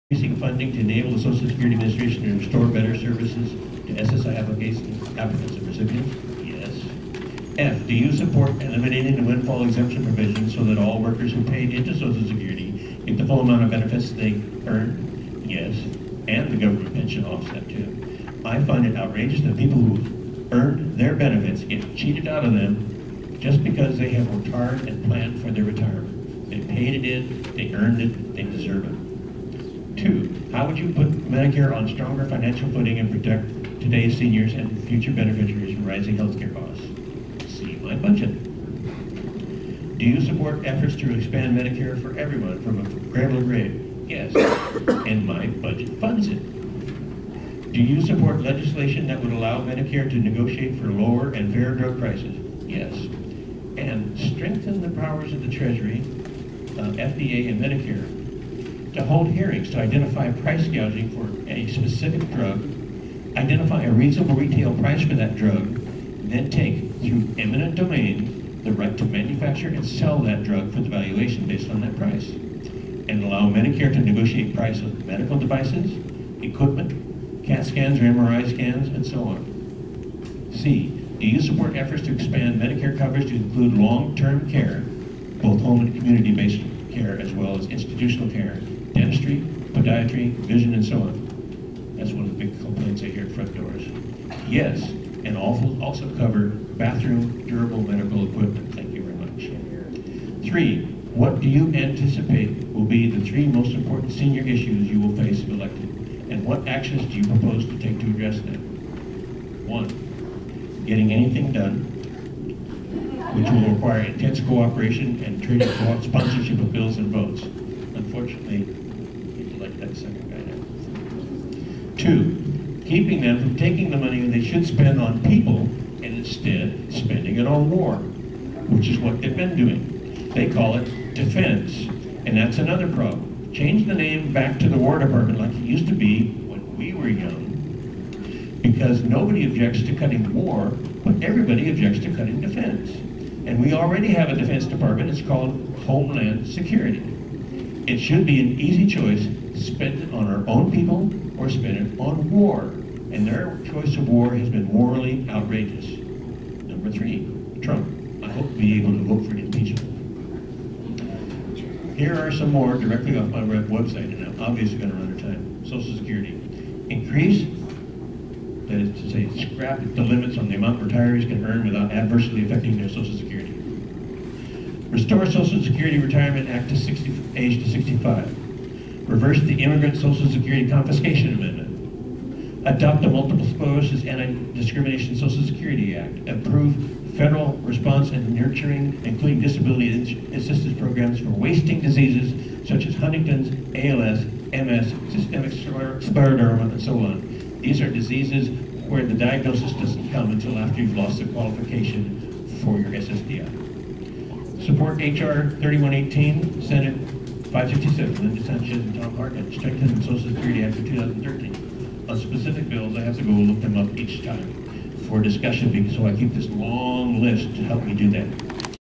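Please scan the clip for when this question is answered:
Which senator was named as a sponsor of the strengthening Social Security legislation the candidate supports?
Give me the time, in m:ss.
3:29.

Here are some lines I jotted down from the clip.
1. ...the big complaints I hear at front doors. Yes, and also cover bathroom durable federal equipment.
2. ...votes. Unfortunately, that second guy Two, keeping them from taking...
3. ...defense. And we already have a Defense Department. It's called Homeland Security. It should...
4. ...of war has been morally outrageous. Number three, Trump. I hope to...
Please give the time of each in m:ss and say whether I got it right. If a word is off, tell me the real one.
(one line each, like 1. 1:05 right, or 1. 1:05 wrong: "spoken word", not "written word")
1. 1:32 wrong: "medical", not "federal"
2. 1:57 right
3. 2:22 right
4. 2:33 right.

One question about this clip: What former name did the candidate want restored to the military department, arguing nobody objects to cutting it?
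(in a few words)
War Department.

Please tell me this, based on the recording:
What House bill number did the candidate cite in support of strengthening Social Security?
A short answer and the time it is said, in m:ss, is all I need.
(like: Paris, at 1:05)
HR 3118, at 3:25.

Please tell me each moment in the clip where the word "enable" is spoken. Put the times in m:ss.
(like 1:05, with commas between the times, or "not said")
0:00.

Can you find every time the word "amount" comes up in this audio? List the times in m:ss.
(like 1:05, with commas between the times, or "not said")
0:13, 2:50.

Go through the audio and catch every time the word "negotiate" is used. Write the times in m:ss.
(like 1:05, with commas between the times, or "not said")
0:50, 1:13.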